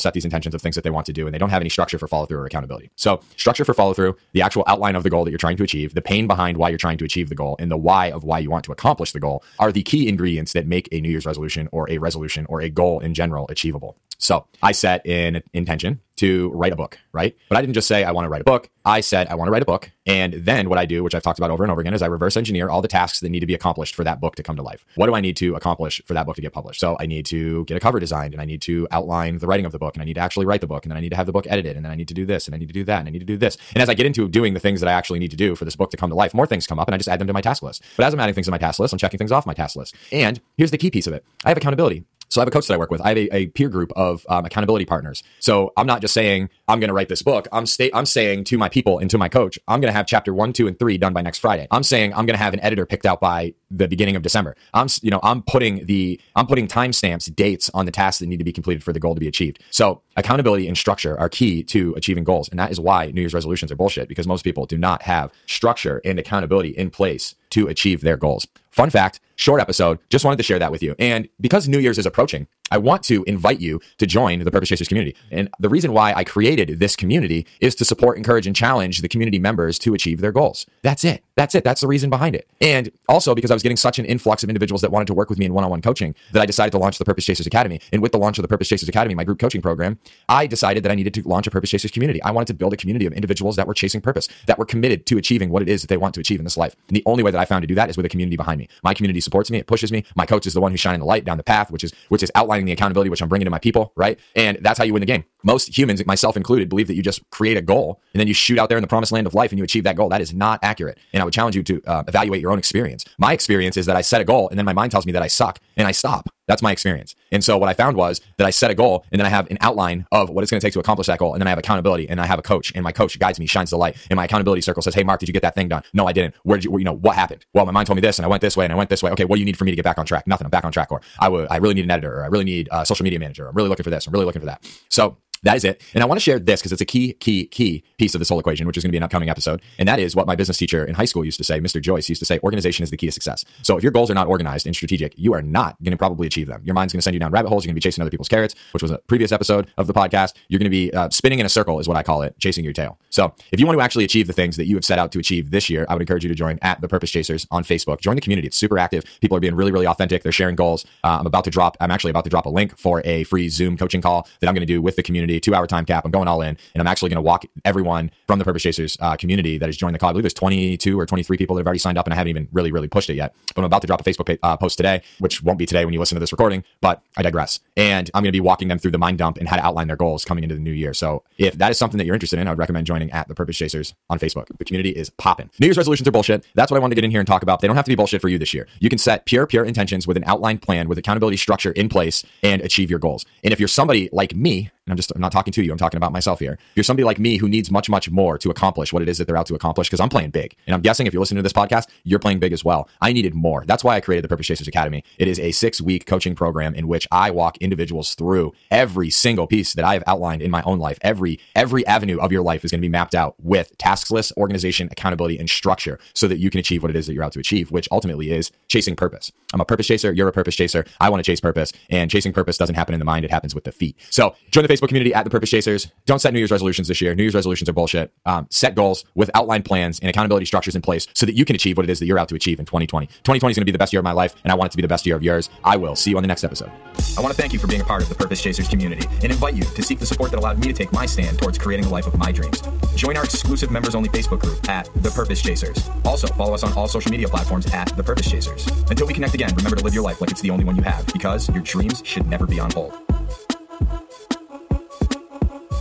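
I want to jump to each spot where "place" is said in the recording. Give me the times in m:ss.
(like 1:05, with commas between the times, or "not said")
1:06, 3:11, 3:50.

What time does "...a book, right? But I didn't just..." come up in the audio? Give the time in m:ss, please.
0:16.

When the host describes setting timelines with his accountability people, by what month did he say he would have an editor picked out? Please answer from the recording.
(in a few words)
December.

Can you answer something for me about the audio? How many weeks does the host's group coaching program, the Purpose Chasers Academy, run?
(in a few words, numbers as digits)
6.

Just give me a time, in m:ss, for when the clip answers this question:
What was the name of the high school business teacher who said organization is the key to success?
2:21.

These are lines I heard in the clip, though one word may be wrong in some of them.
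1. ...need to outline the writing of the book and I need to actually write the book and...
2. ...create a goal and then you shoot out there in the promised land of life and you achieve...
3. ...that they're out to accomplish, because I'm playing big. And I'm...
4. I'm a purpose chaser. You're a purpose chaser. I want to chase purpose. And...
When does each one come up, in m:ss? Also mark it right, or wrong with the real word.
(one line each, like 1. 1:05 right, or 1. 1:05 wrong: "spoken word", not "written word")
1. 0:28 right
2. 1:47 right
3. 3:19 right
4. 3:39 right.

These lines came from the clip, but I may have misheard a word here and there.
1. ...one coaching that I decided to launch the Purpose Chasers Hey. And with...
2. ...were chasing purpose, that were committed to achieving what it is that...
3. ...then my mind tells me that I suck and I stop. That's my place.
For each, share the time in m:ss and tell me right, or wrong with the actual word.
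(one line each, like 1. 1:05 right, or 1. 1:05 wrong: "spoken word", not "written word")
1. 1:25 wrong: "Academy", not "Hey"
2. 1:33 right
3. 1:54 wrong: "experience", not "place".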